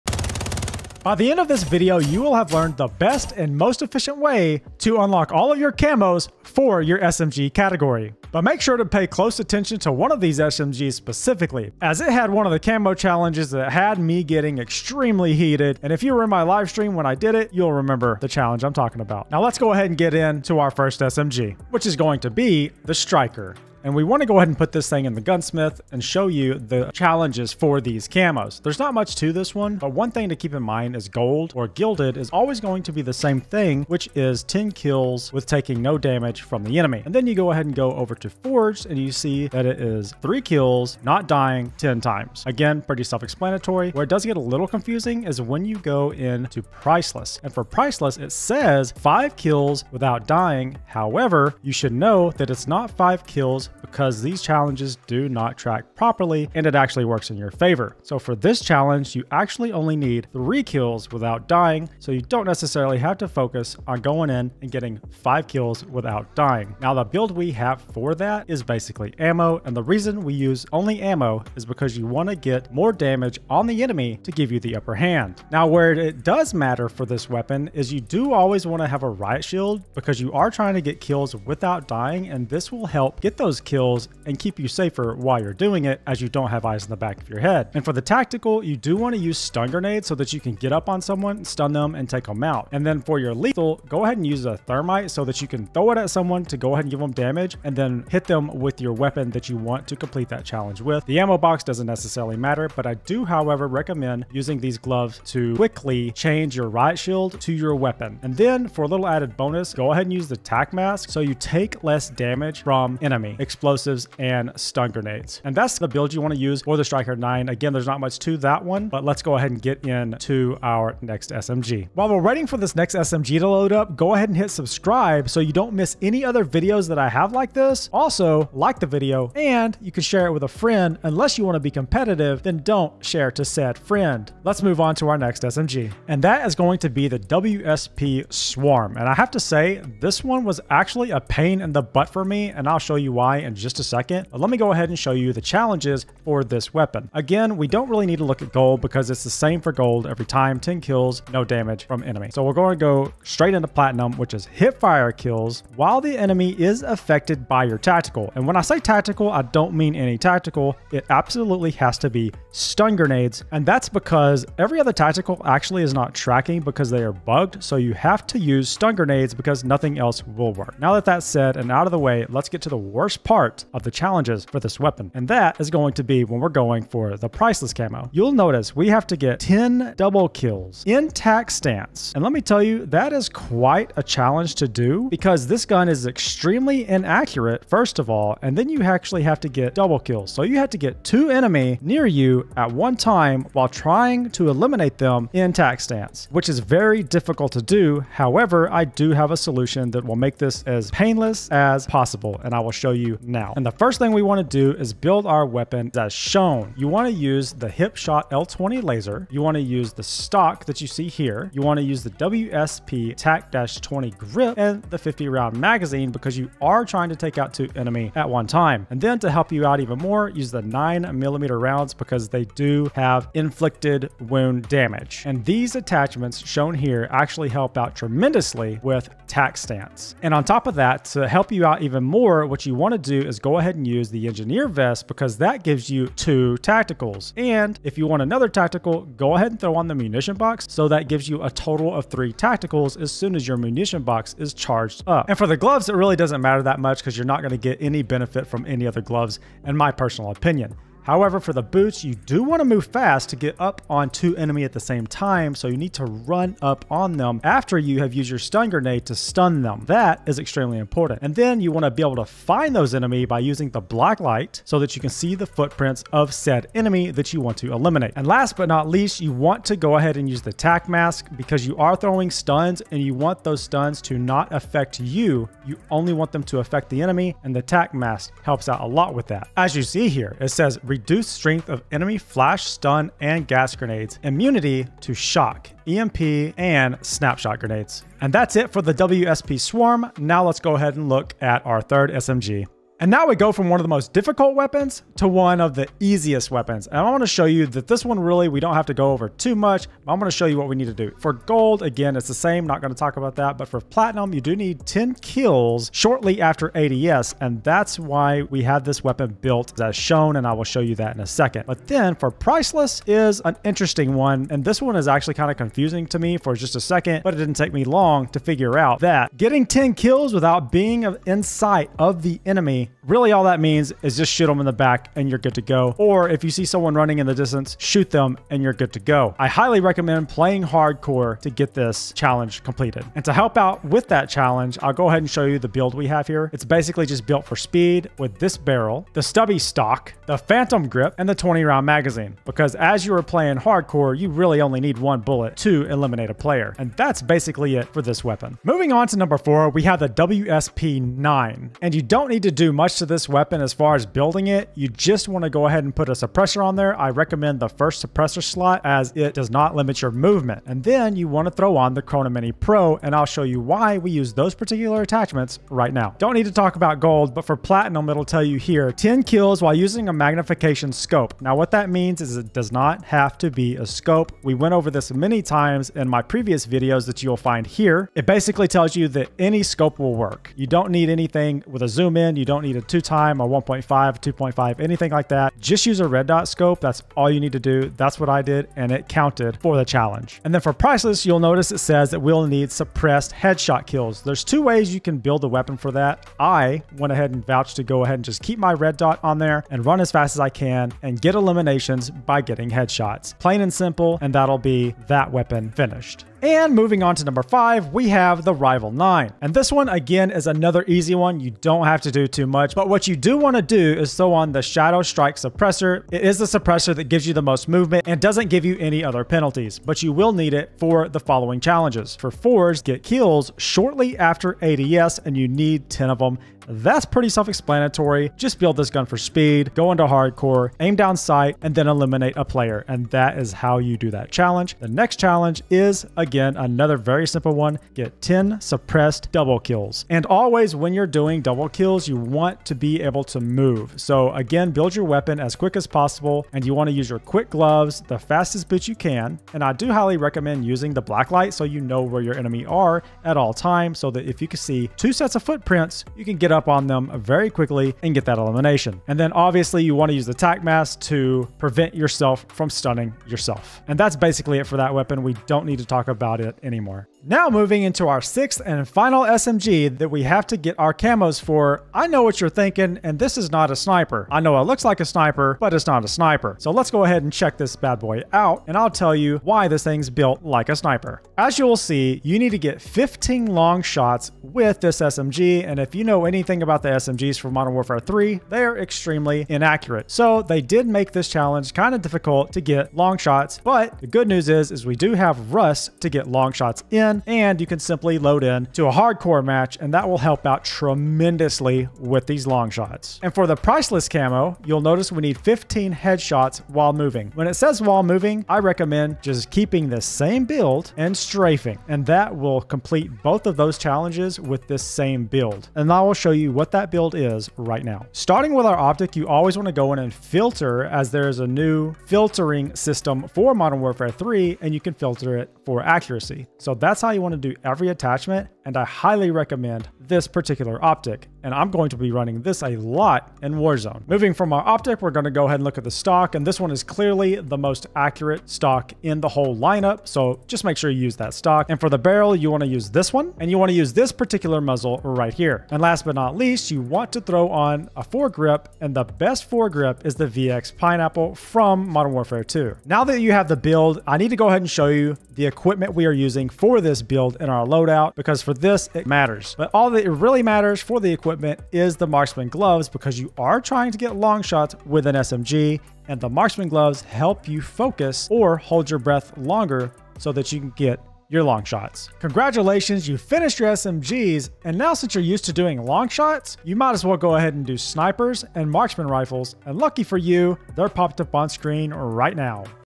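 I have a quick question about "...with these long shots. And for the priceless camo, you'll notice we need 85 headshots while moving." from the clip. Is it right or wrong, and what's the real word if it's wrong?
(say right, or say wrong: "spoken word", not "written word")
wrong: "15", not "85".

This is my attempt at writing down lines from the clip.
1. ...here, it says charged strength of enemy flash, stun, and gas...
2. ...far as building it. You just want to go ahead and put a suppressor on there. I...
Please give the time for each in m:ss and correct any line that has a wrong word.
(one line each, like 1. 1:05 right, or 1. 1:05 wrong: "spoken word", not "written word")
1. 4:40 wrong: "reduced", not "charged"
2. 5:53 right.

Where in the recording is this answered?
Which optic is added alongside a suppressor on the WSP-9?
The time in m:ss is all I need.
6:02.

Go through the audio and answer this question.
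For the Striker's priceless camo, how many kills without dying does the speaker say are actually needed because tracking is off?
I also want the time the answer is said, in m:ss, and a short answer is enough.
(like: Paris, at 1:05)
3, at 0:59.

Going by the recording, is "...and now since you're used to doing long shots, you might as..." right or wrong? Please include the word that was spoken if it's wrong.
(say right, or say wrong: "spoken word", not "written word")
right.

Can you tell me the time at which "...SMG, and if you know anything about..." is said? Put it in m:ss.
8:04.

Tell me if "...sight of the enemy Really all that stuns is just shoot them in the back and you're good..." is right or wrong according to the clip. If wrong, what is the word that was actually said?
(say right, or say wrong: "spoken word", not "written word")
wrong: "means", not "stuns".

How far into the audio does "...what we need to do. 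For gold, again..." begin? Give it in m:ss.
5:00.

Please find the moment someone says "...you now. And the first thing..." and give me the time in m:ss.
3:22.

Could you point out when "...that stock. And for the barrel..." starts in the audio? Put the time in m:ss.
9:01.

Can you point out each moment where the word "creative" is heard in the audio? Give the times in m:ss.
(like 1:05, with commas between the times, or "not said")
not said.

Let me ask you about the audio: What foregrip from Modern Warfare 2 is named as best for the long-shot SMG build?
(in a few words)
VX Pineapple.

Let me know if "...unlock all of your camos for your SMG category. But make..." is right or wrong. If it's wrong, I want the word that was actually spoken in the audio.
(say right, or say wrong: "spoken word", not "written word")
right.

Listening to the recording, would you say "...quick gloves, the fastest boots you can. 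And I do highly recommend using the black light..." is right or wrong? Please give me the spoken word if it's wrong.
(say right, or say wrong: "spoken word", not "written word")
right.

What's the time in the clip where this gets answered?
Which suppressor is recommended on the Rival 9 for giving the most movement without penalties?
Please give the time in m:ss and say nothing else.
6:54.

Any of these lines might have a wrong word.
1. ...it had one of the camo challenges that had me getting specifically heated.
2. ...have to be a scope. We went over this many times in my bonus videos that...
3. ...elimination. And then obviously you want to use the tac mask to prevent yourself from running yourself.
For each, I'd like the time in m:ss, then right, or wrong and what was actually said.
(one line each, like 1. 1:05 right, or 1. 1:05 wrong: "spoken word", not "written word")
1. 0:12 wrong: "extremely", not "specifically"
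2. 6:13 wrong: "previous", not "bonus"
3. 7:38 wrong: "stunning", not "running".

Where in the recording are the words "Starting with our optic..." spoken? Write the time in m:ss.
8:38.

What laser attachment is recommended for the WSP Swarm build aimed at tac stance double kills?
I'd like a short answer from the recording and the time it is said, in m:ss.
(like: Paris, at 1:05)
hip shot L20 laser, at 3:27.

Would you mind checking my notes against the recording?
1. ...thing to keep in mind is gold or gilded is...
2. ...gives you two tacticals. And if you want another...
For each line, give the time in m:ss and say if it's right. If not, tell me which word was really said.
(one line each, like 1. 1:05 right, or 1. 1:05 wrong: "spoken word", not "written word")
1. 0:30 right
2. 3:55 right.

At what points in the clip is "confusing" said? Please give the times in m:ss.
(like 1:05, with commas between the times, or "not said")
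0:44, 5:15.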